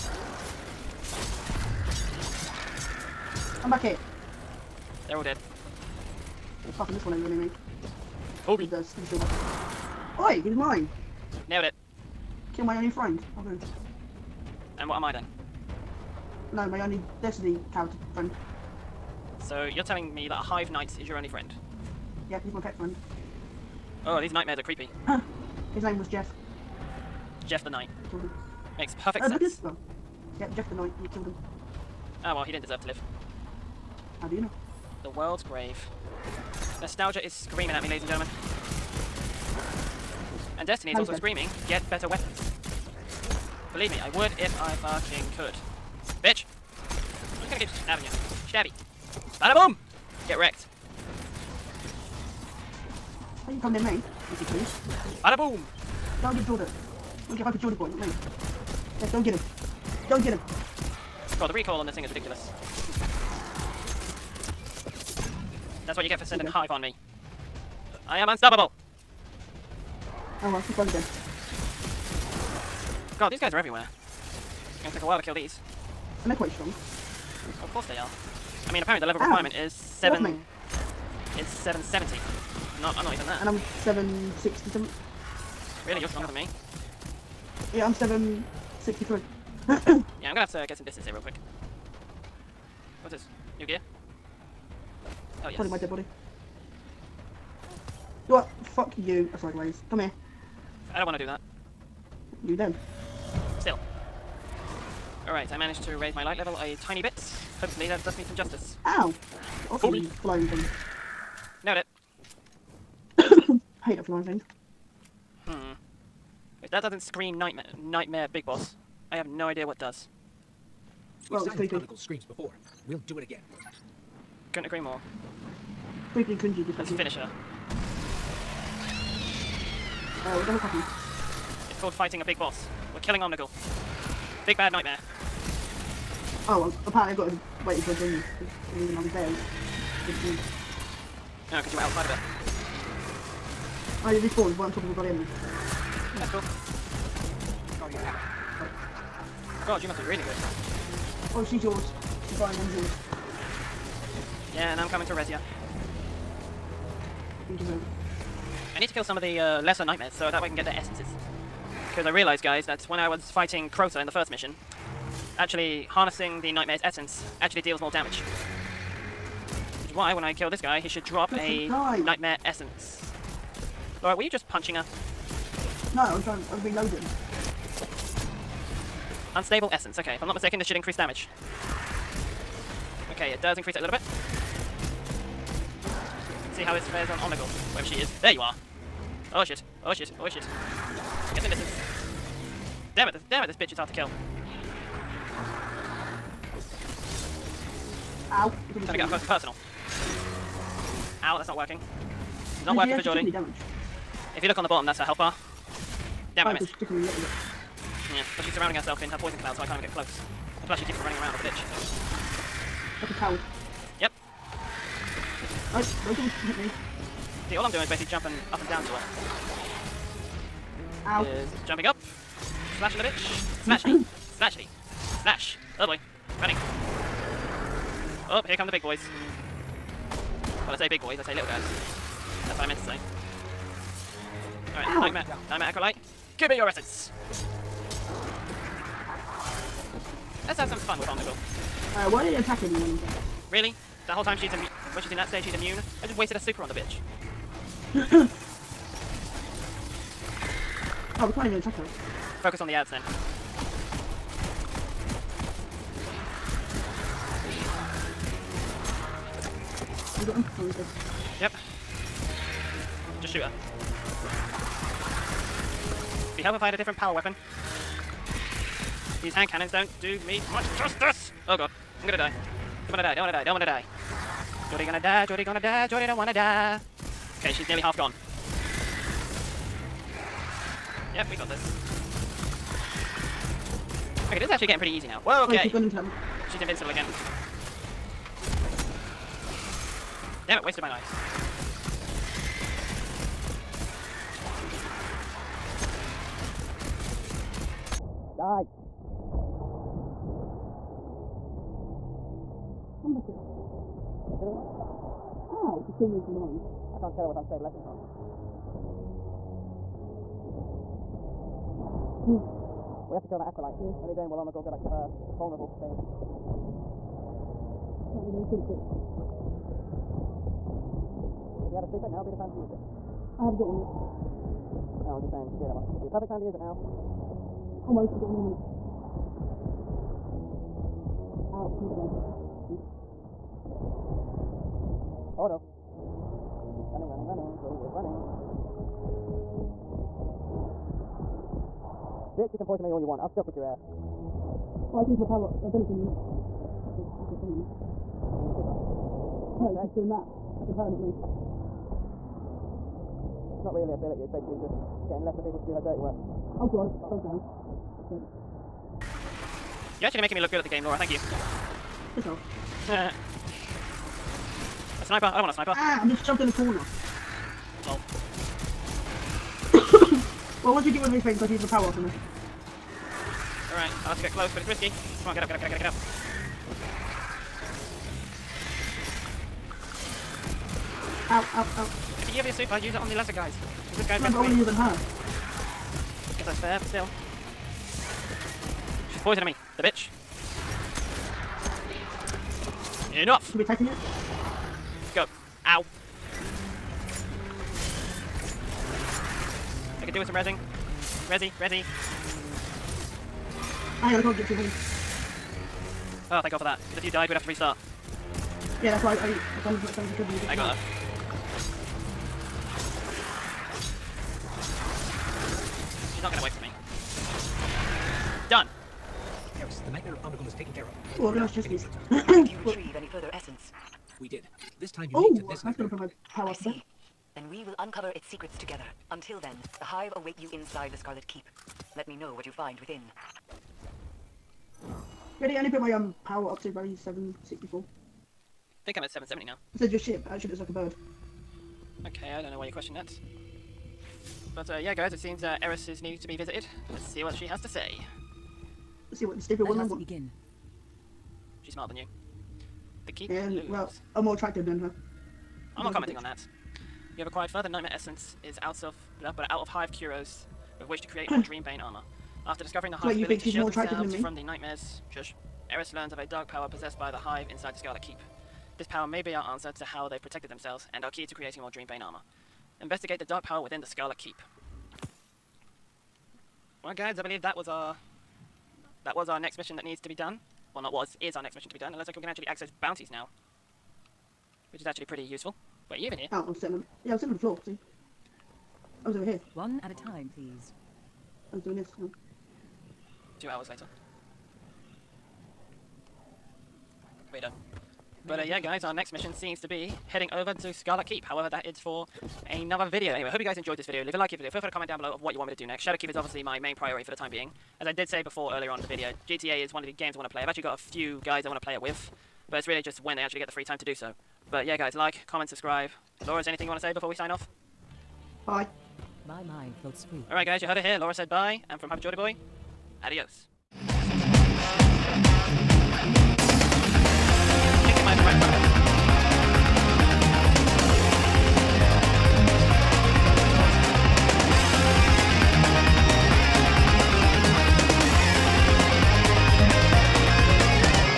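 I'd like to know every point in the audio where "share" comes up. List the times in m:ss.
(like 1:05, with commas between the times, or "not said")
not said.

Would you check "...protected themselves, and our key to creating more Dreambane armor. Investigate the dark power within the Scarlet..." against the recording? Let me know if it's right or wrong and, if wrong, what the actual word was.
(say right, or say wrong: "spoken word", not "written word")
right.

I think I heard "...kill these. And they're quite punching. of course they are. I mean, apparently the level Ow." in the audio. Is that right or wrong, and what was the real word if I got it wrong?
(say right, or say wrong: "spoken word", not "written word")
wrong: "strong", not "punching".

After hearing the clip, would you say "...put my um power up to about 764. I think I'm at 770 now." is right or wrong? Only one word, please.
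right.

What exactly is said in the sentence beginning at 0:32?
oh, well, he didn't deserve to live.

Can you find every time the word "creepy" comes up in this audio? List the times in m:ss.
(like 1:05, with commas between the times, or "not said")
0:24, 2:01, 2:06.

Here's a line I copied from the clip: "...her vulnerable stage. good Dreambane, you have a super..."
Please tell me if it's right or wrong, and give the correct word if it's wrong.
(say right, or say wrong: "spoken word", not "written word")
wrong: "Right", not "Dreambane".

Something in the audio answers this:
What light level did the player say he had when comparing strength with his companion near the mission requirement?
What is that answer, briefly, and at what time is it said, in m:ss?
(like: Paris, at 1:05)
763, at 1:27.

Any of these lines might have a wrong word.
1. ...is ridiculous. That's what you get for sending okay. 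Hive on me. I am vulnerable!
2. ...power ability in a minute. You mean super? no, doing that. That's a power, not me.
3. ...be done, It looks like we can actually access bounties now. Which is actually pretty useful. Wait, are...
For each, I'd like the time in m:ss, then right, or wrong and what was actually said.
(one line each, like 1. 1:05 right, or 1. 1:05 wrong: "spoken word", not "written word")
1. 1:02 wrong: "unstoppable", not "vulnerable"
2. 5:45 right
3. 8:01 right.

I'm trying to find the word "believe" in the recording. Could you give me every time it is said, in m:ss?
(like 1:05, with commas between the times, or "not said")
0:43, 7:57.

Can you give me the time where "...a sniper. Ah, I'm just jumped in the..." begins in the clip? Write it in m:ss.
6:05.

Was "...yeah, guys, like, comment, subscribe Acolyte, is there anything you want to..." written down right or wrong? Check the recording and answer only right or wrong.
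wrong.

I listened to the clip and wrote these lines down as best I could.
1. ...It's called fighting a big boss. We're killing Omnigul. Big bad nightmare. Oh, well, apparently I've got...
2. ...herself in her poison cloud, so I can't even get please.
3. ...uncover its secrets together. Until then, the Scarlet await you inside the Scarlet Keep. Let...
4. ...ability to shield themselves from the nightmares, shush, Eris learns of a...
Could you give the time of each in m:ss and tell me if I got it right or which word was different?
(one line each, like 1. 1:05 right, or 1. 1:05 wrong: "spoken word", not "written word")
1. 2:11 right
2. 3:28 wrong: "close", not "please"
3. 7:07 wrong: "Hive", not "Scarlet"
4. 7:43 right.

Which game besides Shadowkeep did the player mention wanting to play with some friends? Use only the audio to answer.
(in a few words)
GTA.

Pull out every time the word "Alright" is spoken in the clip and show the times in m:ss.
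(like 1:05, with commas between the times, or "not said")
1:45, 3:35, 3:54, 6:13, 8:40.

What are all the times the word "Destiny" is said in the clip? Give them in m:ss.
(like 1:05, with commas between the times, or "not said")
0:17, 0:40.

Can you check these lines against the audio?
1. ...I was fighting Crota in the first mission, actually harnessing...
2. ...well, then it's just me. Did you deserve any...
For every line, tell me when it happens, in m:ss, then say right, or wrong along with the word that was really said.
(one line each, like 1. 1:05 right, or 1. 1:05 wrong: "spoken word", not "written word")
1. 2:42 right
2. 7:01 wrong: "retrieve", not "deserve".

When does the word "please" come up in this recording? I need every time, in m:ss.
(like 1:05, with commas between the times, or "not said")
0:54, 8:10.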